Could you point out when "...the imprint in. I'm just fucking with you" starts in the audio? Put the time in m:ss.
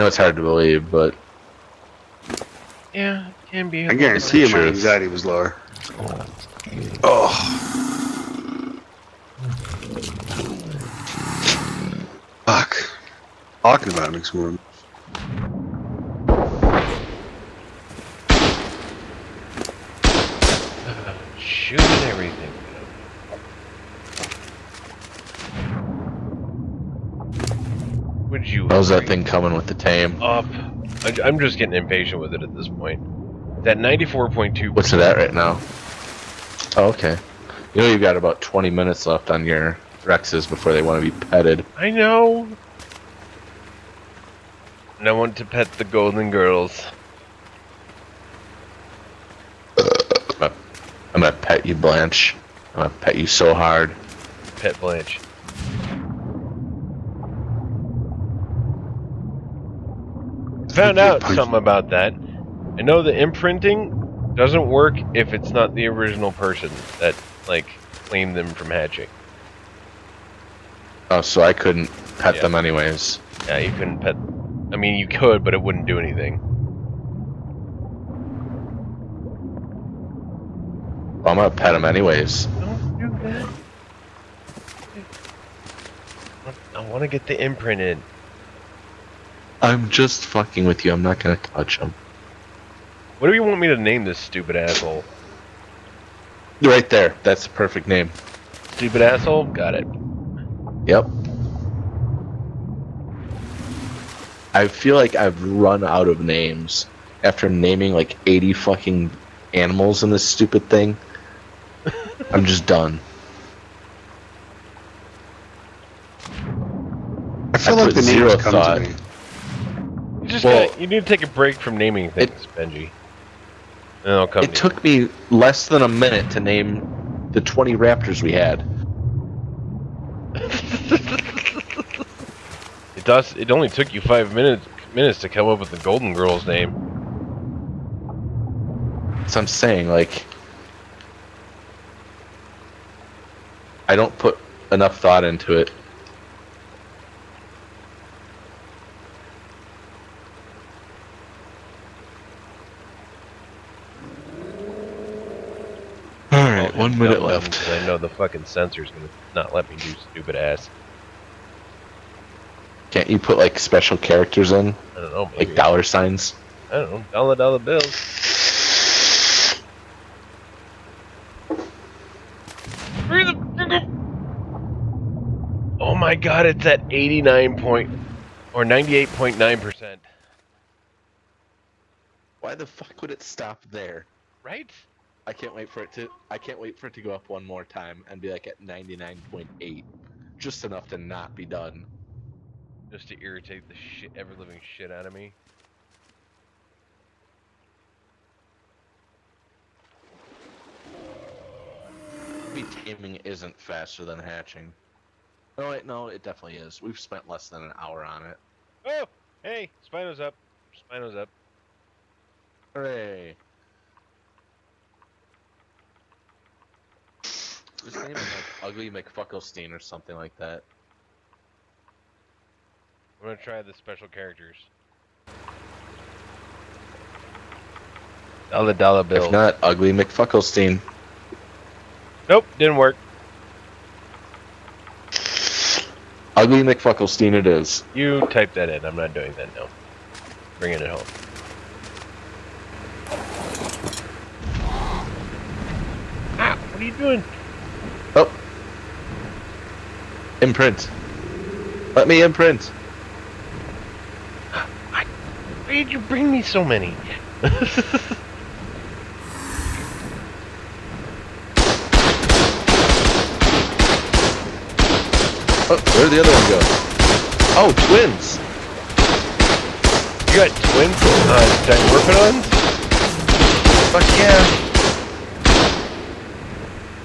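1:27.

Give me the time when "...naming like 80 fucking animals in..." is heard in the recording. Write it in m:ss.
1:47.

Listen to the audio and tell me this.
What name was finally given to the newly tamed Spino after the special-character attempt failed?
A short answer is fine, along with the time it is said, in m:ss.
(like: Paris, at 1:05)
Ugly McFucklestein, at 3:56.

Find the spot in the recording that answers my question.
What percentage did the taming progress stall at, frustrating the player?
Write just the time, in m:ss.
2:58.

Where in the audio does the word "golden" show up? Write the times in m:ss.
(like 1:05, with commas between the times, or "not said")
0:45, 2:15.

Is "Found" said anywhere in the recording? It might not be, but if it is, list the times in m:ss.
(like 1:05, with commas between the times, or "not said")
1:00.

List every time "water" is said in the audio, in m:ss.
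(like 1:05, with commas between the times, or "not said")
not said.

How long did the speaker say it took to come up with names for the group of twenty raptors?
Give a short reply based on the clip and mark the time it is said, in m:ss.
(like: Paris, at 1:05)
less than a minute, at 2:05.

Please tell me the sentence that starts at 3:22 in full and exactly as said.
Maybe taming isn't faster than hatching.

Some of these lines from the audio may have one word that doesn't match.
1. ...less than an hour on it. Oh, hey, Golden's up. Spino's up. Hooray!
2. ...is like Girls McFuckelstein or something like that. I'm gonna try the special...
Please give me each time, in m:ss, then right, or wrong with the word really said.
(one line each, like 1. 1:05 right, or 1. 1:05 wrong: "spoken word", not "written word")
1. 3:27 wrong: "Spino", not "Golden"
2. 3:38 wrong: "Ugly", not "Girls".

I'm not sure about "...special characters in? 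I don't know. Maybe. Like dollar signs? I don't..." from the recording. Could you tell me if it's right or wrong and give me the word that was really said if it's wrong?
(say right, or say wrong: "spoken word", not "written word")
right.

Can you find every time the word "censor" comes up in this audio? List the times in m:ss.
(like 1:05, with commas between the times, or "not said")
2:38.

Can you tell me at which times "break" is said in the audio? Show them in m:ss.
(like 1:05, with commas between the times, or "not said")
2:01.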